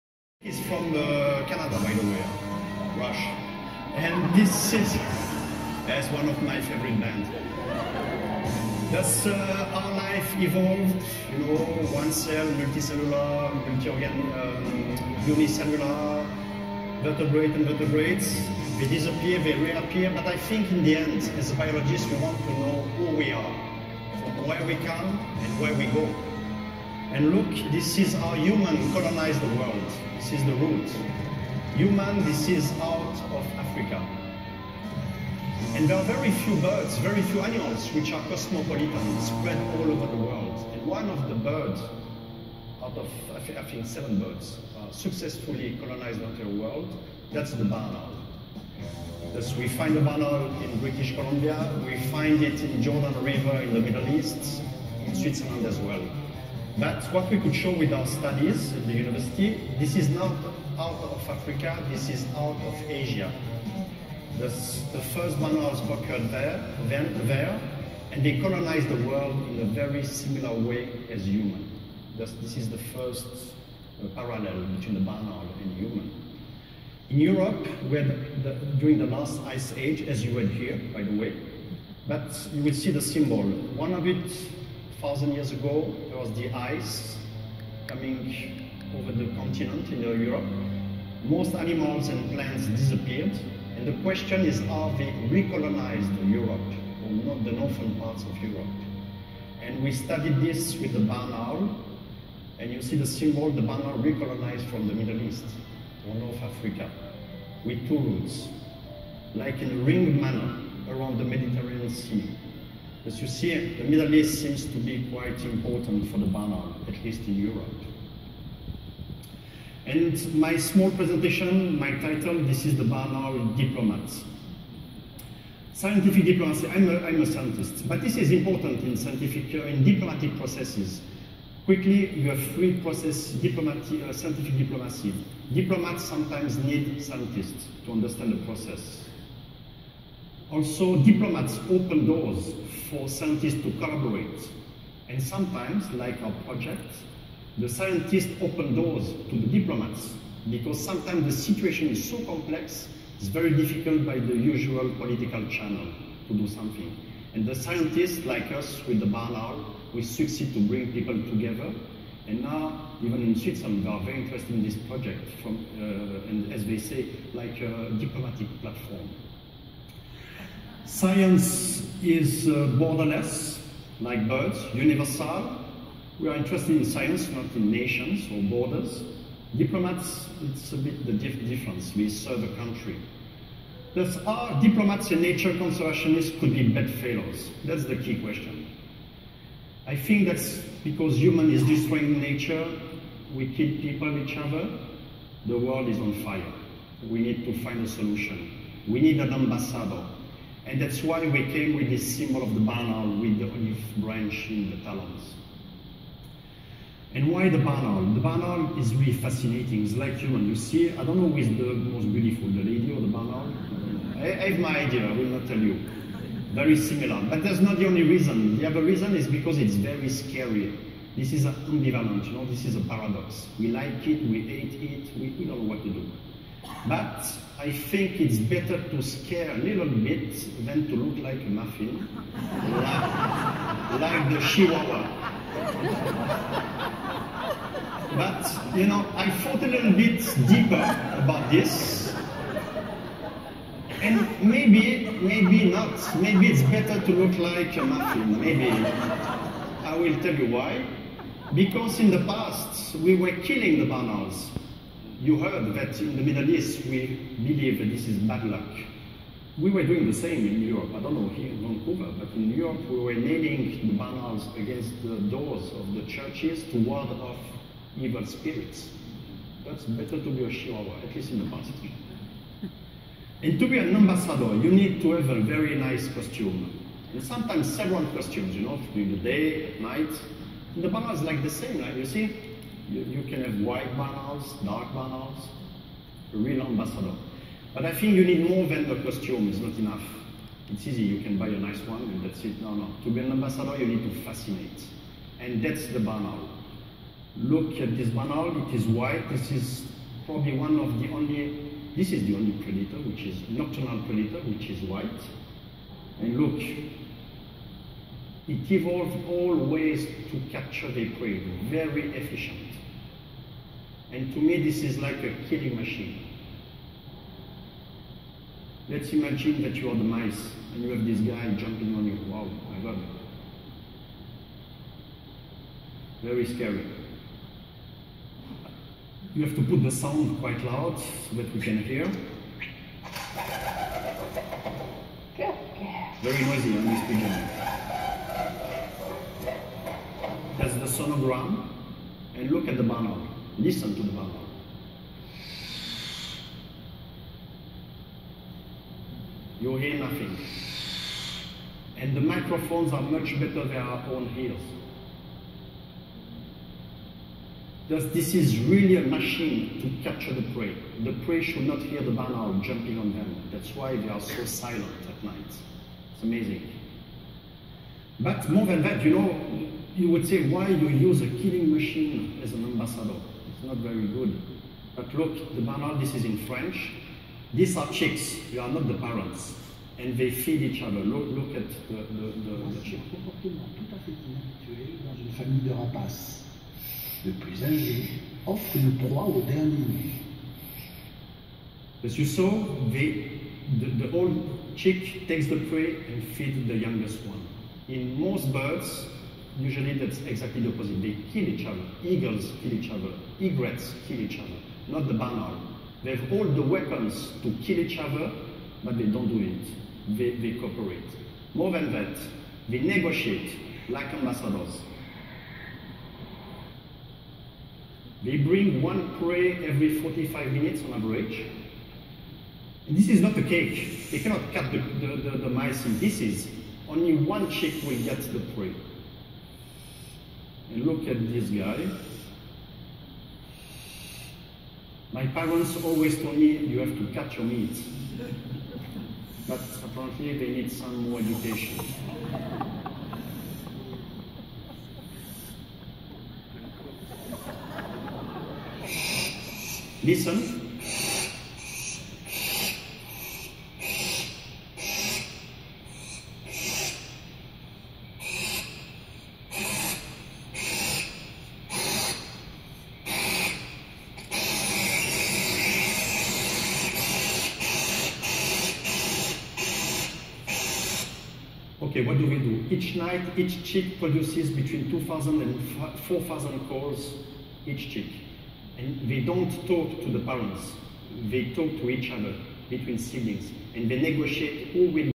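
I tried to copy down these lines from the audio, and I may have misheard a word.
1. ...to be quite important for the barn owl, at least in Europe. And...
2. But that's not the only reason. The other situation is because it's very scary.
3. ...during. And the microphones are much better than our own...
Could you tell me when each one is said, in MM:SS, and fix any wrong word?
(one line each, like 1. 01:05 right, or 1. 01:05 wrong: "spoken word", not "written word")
1. 01:54 right
2. 03:37 wrong: "reason", not "situation"
3. 05:49 wrong: "nothing", not "during".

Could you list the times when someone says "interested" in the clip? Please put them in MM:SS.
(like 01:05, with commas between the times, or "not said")
02:44, 02:56.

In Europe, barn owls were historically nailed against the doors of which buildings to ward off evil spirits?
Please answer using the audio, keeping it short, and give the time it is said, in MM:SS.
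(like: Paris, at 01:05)
Churches, at 04:26.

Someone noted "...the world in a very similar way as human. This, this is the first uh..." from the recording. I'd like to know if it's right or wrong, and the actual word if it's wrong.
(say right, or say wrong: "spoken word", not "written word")
right.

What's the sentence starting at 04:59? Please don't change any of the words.
This is probably one of the only, this is the only predator, which is nocturnal predator, which is white.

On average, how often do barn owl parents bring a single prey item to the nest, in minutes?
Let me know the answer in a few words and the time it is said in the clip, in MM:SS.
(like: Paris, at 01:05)
45, at 07:00.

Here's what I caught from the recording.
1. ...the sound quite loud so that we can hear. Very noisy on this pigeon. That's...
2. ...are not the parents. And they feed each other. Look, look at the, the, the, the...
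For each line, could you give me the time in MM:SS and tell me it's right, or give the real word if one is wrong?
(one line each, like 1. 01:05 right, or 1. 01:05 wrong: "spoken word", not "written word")
1. 05:29 right
2. 06:18 right.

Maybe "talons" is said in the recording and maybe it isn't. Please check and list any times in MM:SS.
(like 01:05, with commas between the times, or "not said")
03:24.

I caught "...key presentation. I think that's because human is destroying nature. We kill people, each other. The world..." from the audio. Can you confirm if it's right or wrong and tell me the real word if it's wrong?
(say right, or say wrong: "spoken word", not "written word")
wrong: "question", not "presentation".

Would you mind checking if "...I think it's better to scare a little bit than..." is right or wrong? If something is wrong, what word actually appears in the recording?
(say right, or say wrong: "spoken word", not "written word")
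right.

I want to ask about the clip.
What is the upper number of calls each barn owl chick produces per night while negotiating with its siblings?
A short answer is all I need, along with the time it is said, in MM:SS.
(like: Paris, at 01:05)
4,000, at 07:56.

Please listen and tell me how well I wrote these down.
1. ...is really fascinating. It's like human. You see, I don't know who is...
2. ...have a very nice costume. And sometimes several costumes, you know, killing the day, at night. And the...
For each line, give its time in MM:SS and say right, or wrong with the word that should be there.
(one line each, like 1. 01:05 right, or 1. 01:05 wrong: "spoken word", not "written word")
1. 03:28 right
2. 04:35 wrong: "during", not "killing".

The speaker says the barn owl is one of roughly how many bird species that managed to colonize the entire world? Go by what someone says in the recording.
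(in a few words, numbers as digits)
7.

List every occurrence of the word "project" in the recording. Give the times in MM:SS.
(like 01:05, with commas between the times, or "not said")
02:26, 02:44.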